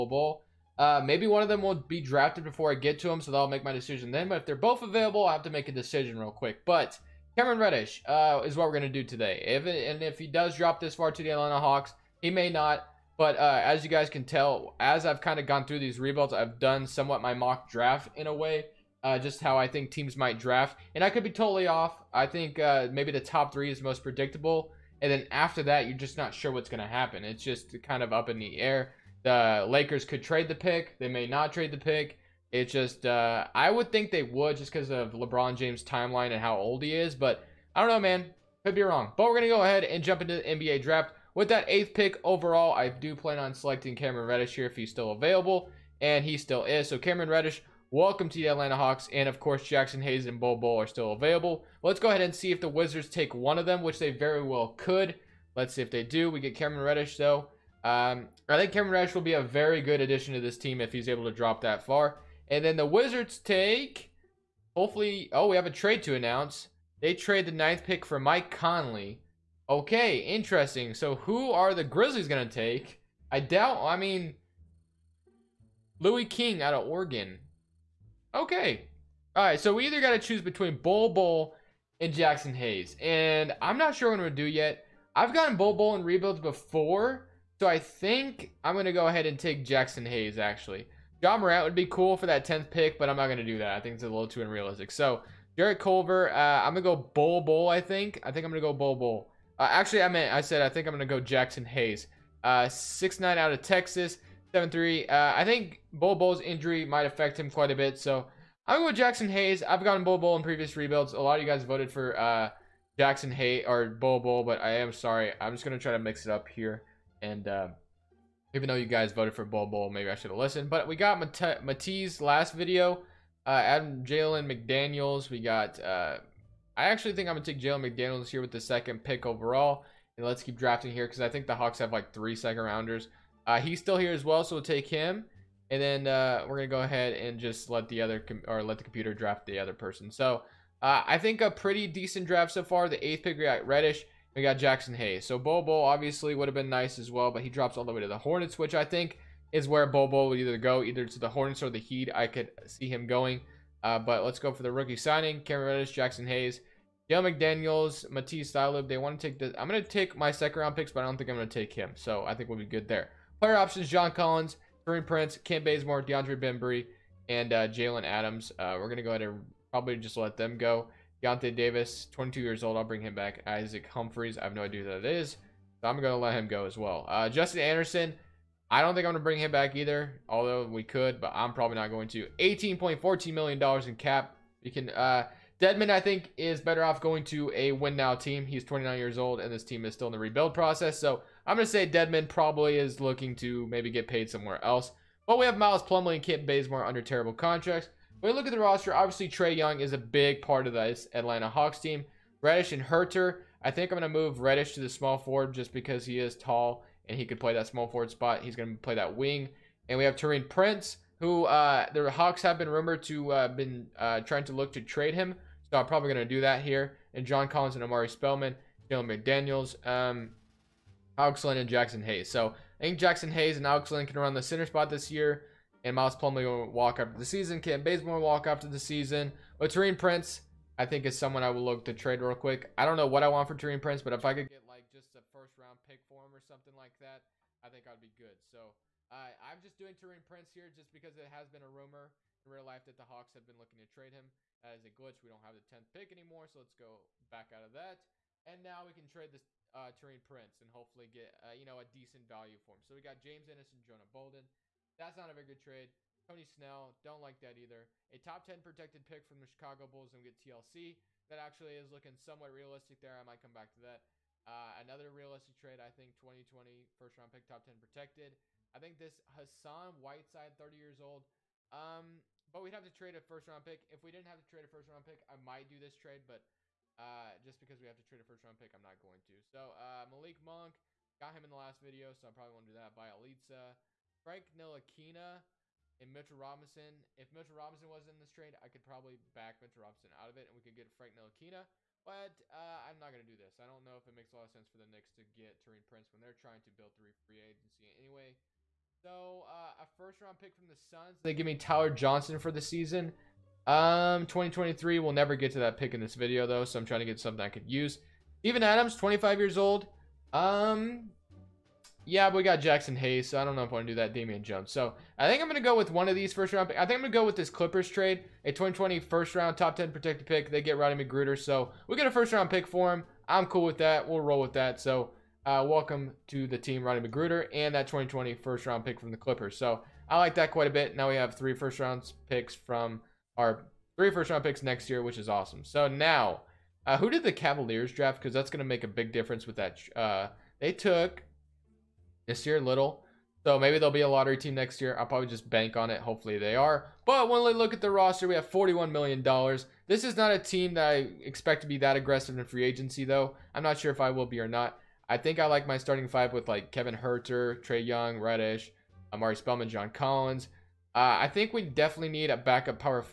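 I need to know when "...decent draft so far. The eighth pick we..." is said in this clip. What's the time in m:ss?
2:21.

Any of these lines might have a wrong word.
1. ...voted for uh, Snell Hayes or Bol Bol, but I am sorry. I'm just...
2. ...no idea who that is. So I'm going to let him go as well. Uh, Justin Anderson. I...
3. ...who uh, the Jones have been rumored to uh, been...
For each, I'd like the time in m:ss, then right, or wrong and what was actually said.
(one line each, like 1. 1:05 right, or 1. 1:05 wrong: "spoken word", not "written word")
1. 1:51 wrong: "Jaxson", not "Snell"
2. 2:54 right
3. 3:31 wrong: "Hawks", not "Jones".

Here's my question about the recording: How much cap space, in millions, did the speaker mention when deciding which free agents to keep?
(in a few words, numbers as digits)
$18.14 million.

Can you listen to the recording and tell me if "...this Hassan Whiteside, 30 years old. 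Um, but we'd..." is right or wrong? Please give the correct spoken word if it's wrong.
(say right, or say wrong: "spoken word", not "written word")
right.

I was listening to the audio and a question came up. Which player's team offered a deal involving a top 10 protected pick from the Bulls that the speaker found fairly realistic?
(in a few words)
TLC.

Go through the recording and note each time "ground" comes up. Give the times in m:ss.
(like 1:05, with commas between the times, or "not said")
not said.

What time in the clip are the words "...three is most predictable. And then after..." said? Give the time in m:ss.
0:23.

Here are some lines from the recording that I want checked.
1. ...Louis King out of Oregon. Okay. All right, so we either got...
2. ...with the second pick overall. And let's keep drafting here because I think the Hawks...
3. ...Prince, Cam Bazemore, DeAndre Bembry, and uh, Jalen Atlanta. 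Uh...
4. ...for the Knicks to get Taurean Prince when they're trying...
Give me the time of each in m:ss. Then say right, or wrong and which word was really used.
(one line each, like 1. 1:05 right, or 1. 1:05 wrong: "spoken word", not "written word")
1. 1:15 right
2. 2:08 right
3. 2:45 wrong: "Adams", not "Atlanta"
4. 4:54 right.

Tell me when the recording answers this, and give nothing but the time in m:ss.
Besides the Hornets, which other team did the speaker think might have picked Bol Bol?
2:31.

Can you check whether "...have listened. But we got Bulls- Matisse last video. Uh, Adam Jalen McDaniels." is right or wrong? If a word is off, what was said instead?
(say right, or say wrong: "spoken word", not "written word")
wrong: "Mate", not "Bulls".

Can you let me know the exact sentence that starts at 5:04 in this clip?
We'll never get to that pick in this video though, so I'm trying to get something I could use.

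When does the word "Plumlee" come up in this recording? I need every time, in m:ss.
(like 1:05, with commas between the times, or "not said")
3:15, 3:46.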